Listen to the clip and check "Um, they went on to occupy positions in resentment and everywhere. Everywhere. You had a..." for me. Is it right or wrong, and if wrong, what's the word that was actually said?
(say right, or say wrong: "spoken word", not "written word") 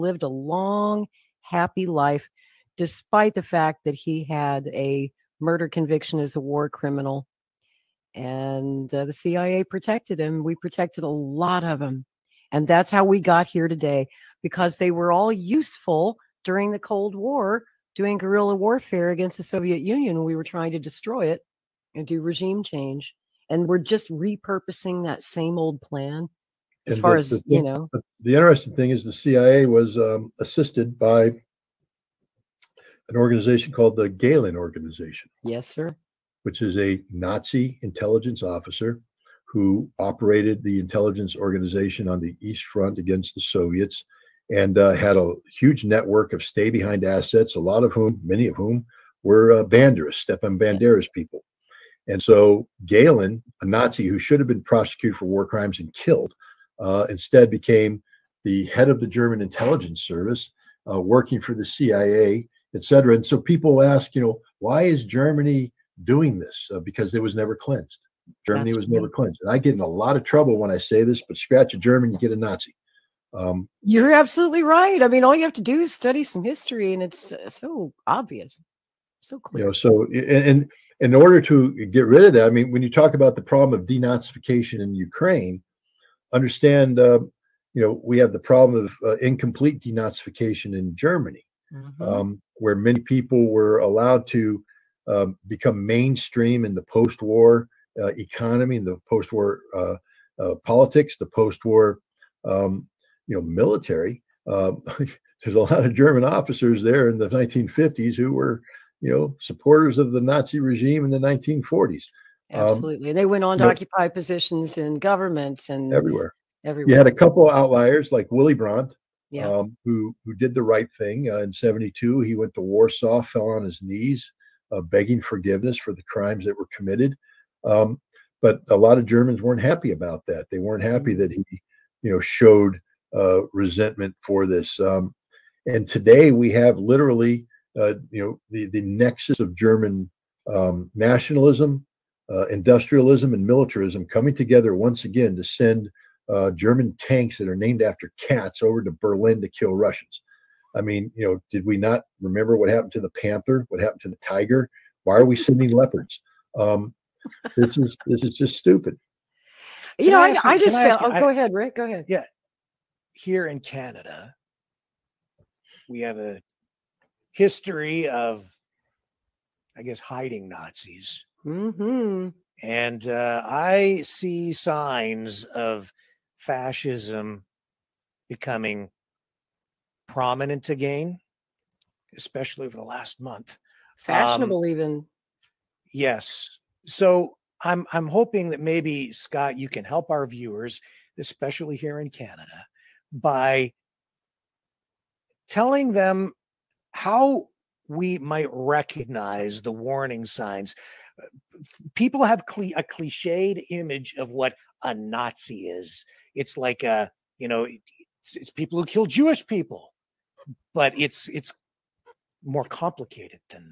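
wrong: "government", not "resentment".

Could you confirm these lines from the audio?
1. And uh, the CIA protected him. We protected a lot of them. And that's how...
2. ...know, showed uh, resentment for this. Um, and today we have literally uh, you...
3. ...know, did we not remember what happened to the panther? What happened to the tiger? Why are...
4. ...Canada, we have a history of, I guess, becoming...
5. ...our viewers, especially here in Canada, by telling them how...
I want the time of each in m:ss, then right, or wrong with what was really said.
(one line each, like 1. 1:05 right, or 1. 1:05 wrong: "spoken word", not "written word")
1. 0:08 right
2. 2:12 right
3. 2:31 right
4. 2:43 wrong: "hiding", not "becoming"
5. 3:10 right.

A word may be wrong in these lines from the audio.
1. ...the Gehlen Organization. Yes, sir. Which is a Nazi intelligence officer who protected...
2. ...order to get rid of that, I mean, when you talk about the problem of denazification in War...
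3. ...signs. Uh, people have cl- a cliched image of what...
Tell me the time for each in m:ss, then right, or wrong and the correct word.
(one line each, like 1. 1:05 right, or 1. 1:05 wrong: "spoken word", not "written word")
1. 0:33 wrong: "operated", not "protected"
2. 1:21 wrong: "Ukraine", not "War"
3. 3:20 right.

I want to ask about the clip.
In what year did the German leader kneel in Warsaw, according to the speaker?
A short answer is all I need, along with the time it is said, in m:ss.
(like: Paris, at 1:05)
1972, at 2:01.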